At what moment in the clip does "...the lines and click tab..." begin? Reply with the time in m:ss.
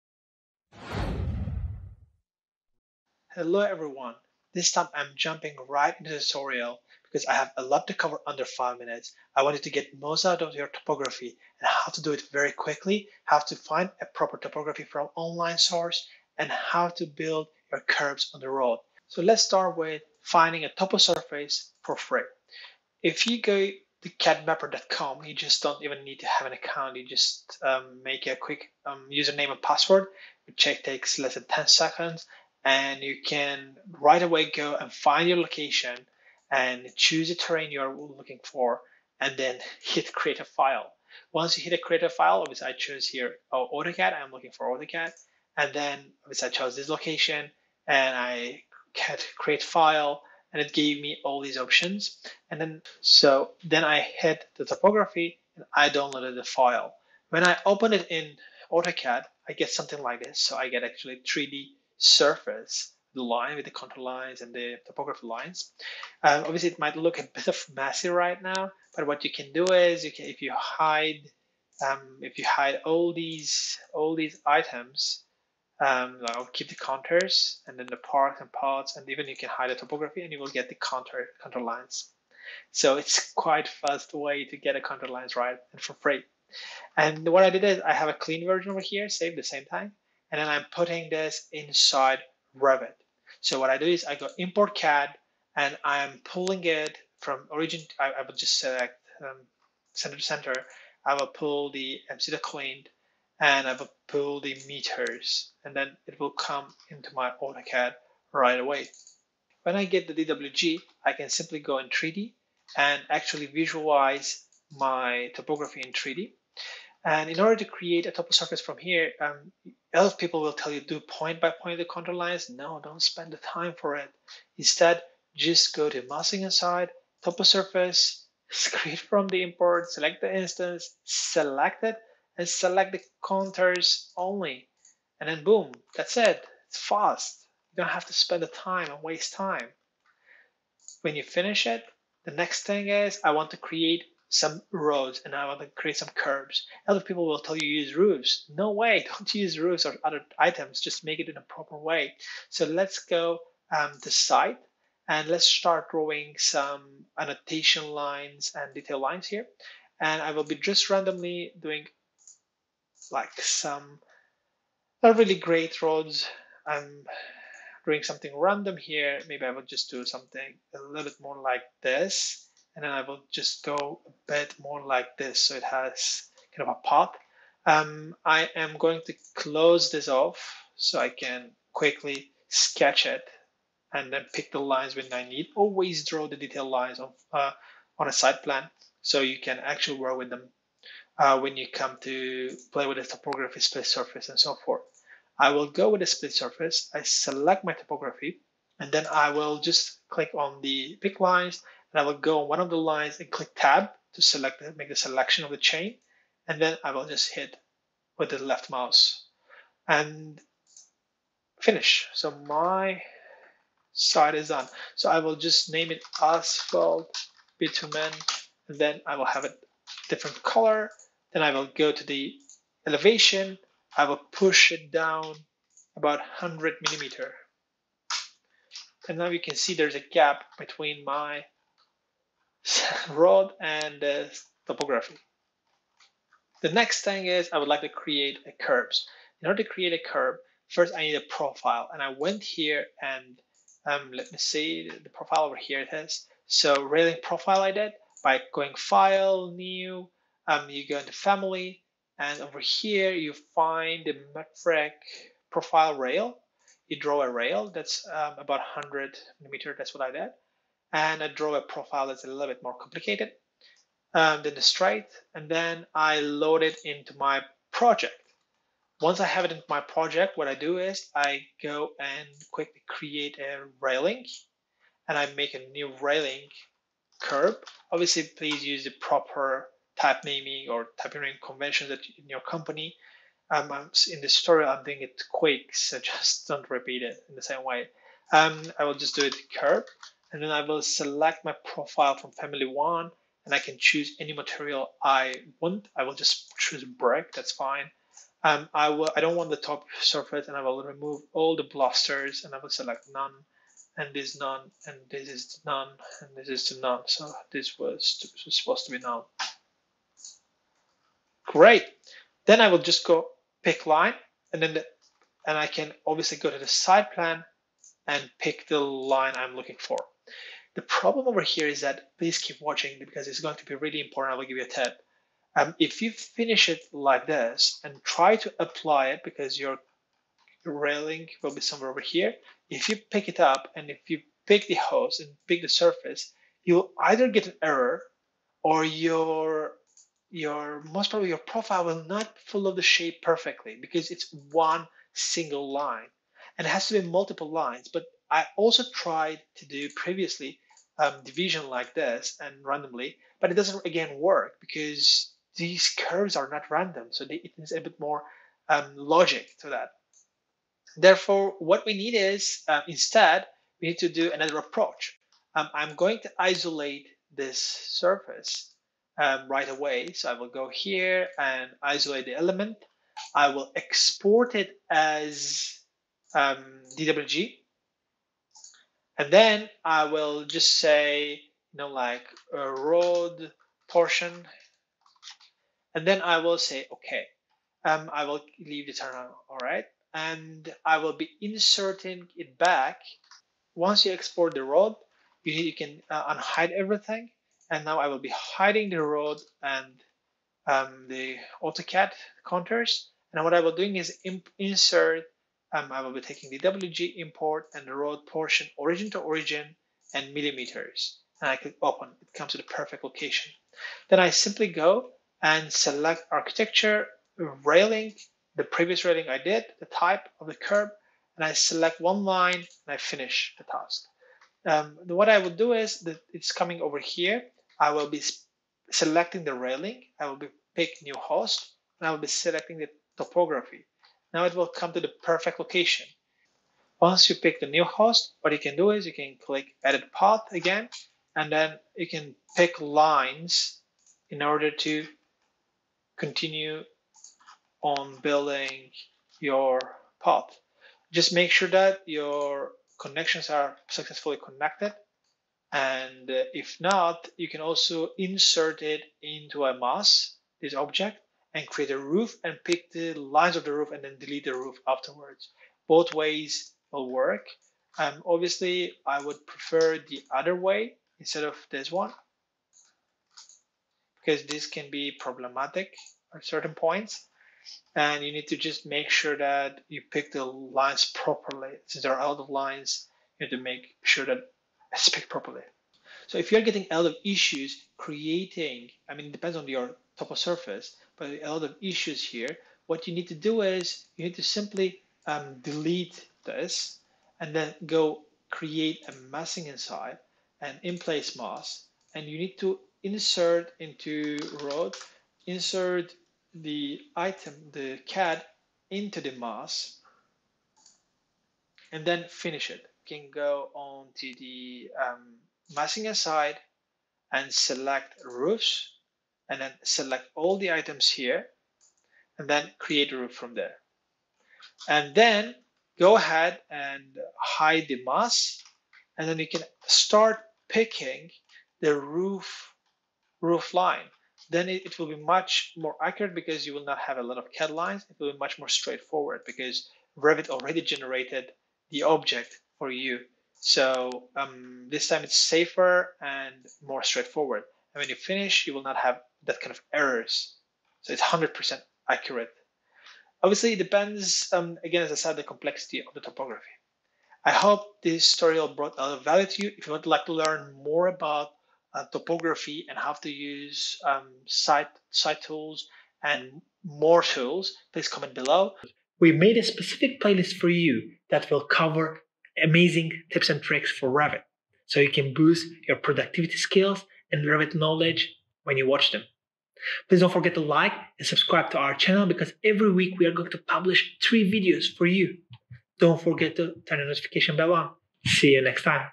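3:22.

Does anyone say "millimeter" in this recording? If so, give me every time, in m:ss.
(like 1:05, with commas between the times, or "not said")
3:46, 4:19, 6:50.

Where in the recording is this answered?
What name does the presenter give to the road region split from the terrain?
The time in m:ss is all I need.
3:36.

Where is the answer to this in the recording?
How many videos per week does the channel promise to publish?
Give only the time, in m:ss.
9:44.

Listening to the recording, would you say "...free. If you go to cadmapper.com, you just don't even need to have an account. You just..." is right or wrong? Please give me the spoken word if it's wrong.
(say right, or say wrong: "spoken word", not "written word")
right.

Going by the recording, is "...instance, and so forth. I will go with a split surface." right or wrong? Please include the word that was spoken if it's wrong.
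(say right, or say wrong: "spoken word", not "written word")
wrong: "surface", not "instance".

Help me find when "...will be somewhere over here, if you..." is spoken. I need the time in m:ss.
5:31.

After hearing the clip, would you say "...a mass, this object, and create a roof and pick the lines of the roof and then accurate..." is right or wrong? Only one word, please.
wrong.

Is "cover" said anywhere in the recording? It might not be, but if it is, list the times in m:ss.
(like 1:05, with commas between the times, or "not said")
0:07, 9:31.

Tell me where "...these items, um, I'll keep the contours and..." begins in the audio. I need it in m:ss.
1:14.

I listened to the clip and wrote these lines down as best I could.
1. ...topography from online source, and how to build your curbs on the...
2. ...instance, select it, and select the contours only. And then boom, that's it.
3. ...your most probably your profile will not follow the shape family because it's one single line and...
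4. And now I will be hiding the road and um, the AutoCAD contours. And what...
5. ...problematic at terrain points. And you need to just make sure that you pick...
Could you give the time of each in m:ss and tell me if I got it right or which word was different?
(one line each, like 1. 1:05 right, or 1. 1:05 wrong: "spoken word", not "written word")
1. 0:14 right
2. 2:10 right
3. 5:40 wrong: "perfectly", not "family"
4. 6:37 right
5. 7:55 wrong: "certain", not "terrain".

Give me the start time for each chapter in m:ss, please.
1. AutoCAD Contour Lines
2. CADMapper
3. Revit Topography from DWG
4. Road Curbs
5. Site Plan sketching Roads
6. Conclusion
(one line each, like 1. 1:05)
1. 0:57
2. 0:20
3. 1:32
4. 4:00
5. 2:35
6. 9:17.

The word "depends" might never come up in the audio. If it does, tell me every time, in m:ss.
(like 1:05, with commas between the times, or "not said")
8:09, 9:13.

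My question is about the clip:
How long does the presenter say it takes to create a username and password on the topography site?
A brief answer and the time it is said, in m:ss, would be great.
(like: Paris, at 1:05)
less than 10 seconds, at 0:31.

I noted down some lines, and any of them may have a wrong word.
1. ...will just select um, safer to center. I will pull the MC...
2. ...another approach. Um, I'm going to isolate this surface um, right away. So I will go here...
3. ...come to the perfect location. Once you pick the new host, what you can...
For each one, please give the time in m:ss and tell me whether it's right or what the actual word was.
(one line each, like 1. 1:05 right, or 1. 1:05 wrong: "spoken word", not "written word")
1. 1:38 wrong: "center", not "safer"
2. 6:04 right
3. 7:14 right.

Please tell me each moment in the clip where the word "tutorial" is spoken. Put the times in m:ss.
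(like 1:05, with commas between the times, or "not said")
0:06, 9:18.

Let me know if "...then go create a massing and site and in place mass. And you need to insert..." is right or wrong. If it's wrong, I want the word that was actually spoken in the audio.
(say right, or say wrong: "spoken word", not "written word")
right.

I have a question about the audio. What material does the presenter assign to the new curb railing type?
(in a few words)
brick.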